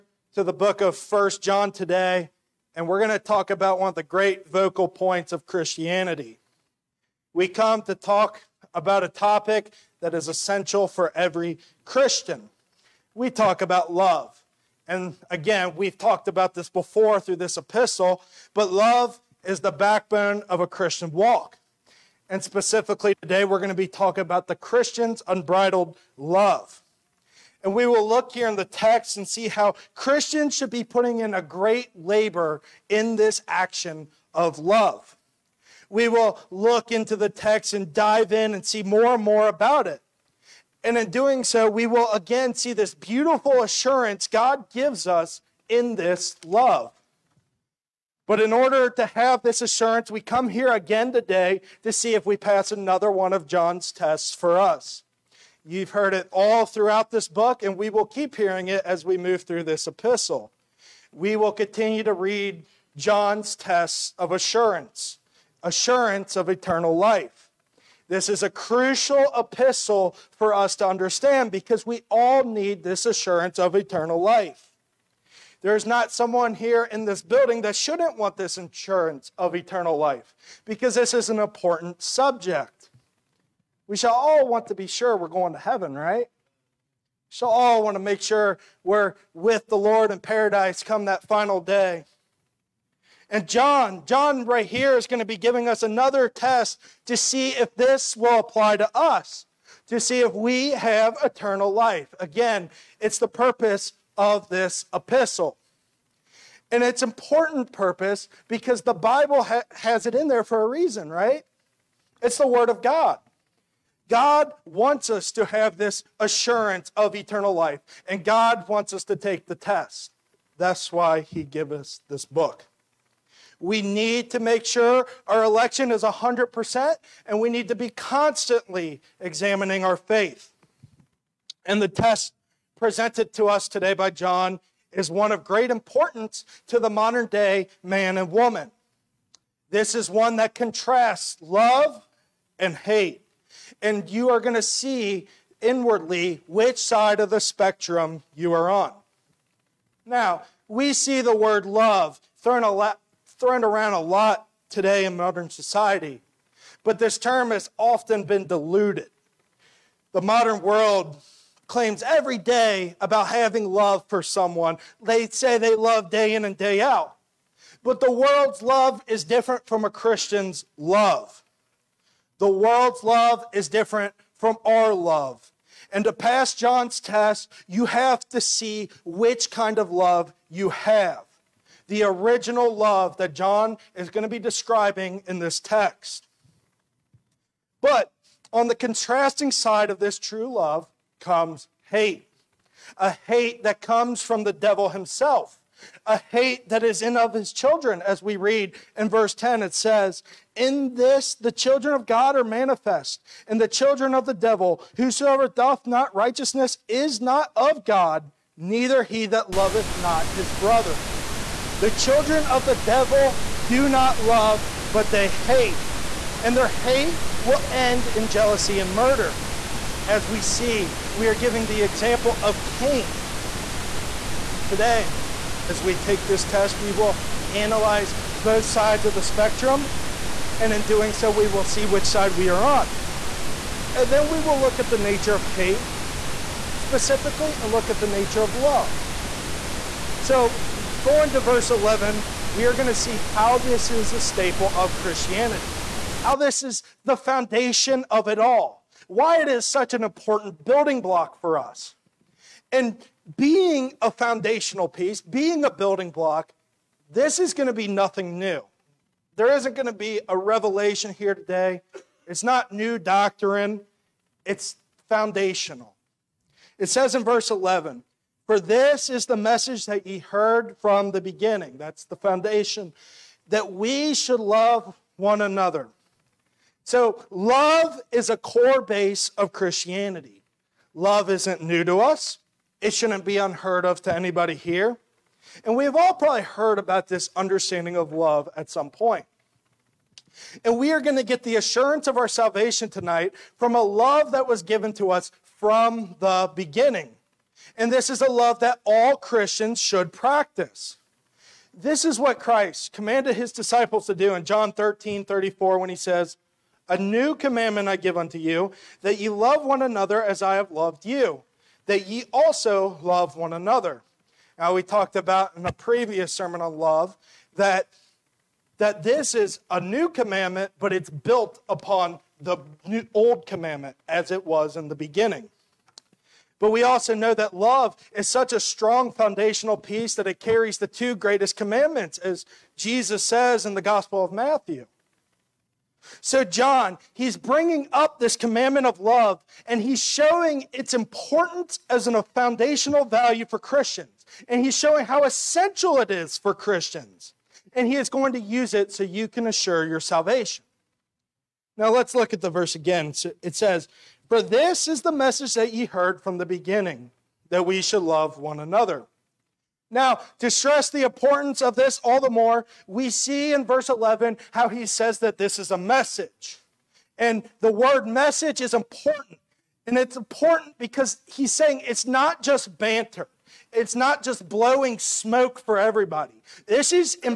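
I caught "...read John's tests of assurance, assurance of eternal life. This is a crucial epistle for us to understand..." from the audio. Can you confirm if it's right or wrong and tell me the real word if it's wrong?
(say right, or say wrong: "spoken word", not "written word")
right.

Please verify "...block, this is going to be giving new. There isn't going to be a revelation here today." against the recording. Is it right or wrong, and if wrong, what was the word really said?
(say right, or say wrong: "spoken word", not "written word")
wrong: "nothing", not "giving".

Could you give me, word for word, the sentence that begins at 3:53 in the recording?
And then we will look at the nature of hate specifically and look at the nature of love.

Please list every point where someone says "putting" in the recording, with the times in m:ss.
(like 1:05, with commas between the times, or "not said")
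0:30.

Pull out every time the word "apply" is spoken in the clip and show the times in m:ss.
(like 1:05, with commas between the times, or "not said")
1:38.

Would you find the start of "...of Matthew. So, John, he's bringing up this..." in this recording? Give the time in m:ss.
5:34.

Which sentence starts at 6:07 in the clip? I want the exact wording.
And the word message is important.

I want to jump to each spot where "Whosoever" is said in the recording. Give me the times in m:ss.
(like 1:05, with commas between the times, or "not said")
3:24.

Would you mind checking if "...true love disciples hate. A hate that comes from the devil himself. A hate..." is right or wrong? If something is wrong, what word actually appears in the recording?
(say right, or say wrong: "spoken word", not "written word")
wrong: "comes", not "disciples".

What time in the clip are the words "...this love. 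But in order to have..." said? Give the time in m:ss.
0:45.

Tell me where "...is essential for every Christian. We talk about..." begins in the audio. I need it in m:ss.
0:10.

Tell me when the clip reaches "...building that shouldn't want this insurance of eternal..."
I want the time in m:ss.
1:17.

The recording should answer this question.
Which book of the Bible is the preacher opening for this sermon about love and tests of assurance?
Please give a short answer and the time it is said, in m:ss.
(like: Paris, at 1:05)
First John, at 0:00.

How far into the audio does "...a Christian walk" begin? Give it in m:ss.
0:20.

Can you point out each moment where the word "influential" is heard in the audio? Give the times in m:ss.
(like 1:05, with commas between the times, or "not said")
not said.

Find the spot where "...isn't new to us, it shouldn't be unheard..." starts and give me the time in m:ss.
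4:41.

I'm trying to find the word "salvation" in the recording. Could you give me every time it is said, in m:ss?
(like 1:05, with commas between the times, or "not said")
4:52, 5:50.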